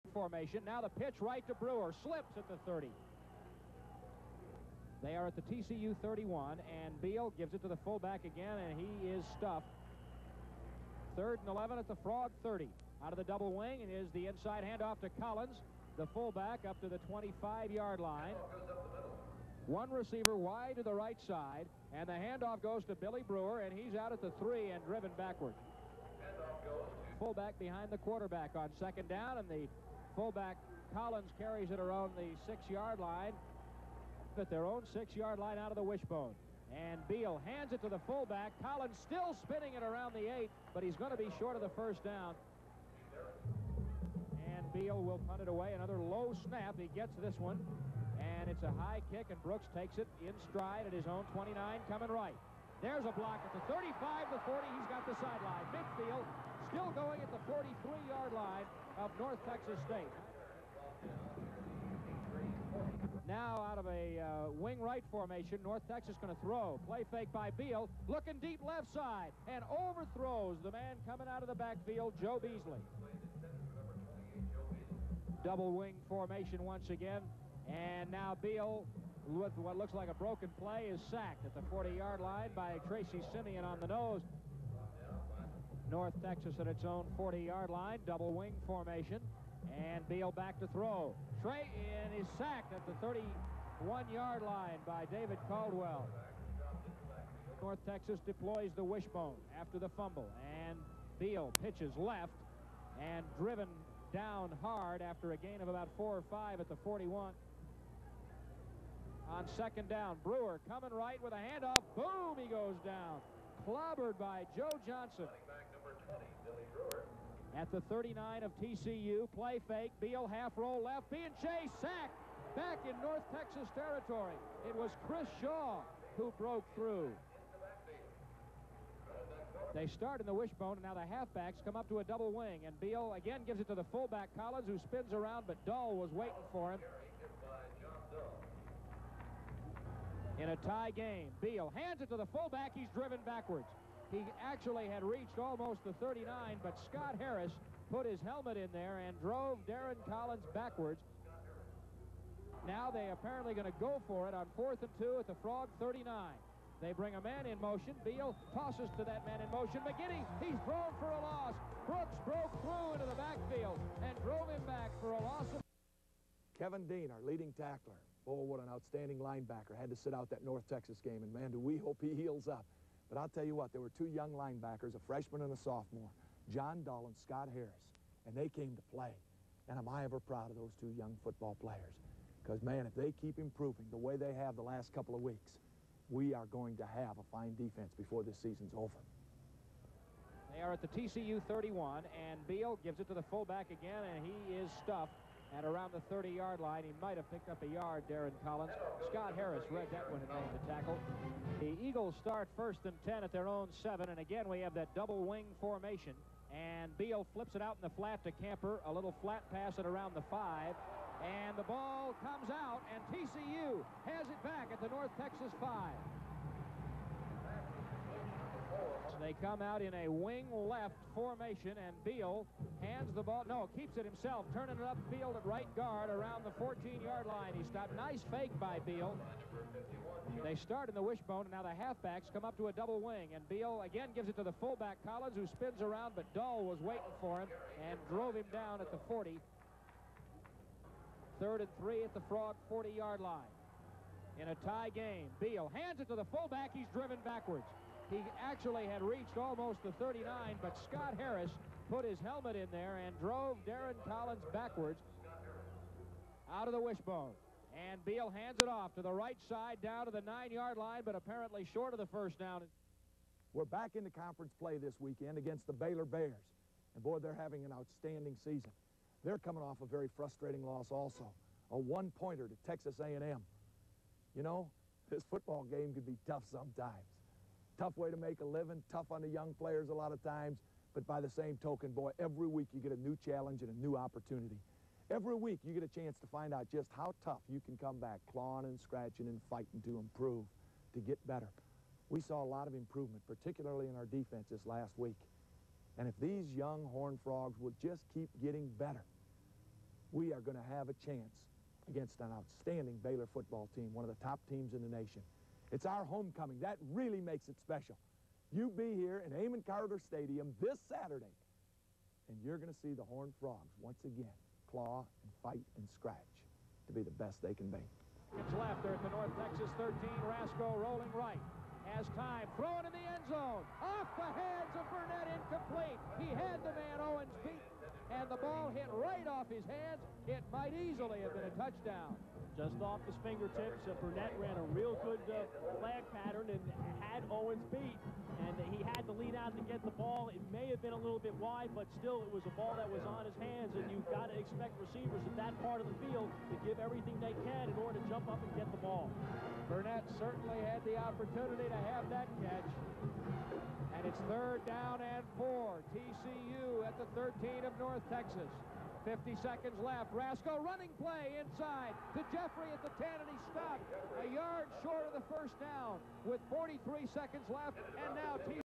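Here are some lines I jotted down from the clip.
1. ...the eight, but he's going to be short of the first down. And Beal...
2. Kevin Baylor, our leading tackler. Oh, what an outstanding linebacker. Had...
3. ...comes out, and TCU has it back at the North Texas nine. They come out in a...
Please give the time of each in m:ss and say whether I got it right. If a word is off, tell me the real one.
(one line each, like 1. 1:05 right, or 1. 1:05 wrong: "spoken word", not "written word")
1. 0:40 right
2. 2:46 wrong: "Dean", not "Baylor"
3. 3:32 wrong: "five", not "nine".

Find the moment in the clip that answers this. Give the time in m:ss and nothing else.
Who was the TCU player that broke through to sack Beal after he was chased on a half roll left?
2:05.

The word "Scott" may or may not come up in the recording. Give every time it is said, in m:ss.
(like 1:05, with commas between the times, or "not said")
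2:26, 2:57, 3:19, 4:10.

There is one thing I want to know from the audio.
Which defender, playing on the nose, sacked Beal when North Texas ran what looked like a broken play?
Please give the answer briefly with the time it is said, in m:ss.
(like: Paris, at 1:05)
Tracy Simeon, at 1:22.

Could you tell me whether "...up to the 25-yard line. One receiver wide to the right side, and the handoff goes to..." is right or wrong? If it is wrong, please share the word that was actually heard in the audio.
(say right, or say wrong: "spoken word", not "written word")
right.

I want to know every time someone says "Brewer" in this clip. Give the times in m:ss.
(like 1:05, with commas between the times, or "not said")
0:01, 0:23, 1:50.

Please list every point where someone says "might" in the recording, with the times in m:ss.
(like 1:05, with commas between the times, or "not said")
3:17, 5:30.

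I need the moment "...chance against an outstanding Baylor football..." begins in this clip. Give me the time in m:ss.
5:01.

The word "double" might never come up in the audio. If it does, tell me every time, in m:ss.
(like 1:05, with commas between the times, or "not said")
0:13, 1:15, 1:28, 2:12, 3:24, 3:52.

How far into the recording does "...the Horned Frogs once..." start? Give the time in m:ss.
5:12.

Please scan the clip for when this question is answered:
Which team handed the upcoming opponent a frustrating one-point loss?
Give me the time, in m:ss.
4:32.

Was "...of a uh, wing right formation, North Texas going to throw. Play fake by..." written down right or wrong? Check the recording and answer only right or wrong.
right.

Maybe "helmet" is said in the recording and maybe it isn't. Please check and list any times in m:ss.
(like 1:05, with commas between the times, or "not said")
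2:28, 4:12.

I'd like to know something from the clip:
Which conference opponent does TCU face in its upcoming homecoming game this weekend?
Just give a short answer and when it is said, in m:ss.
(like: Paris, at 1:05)
Baylor Bears, at 4:25.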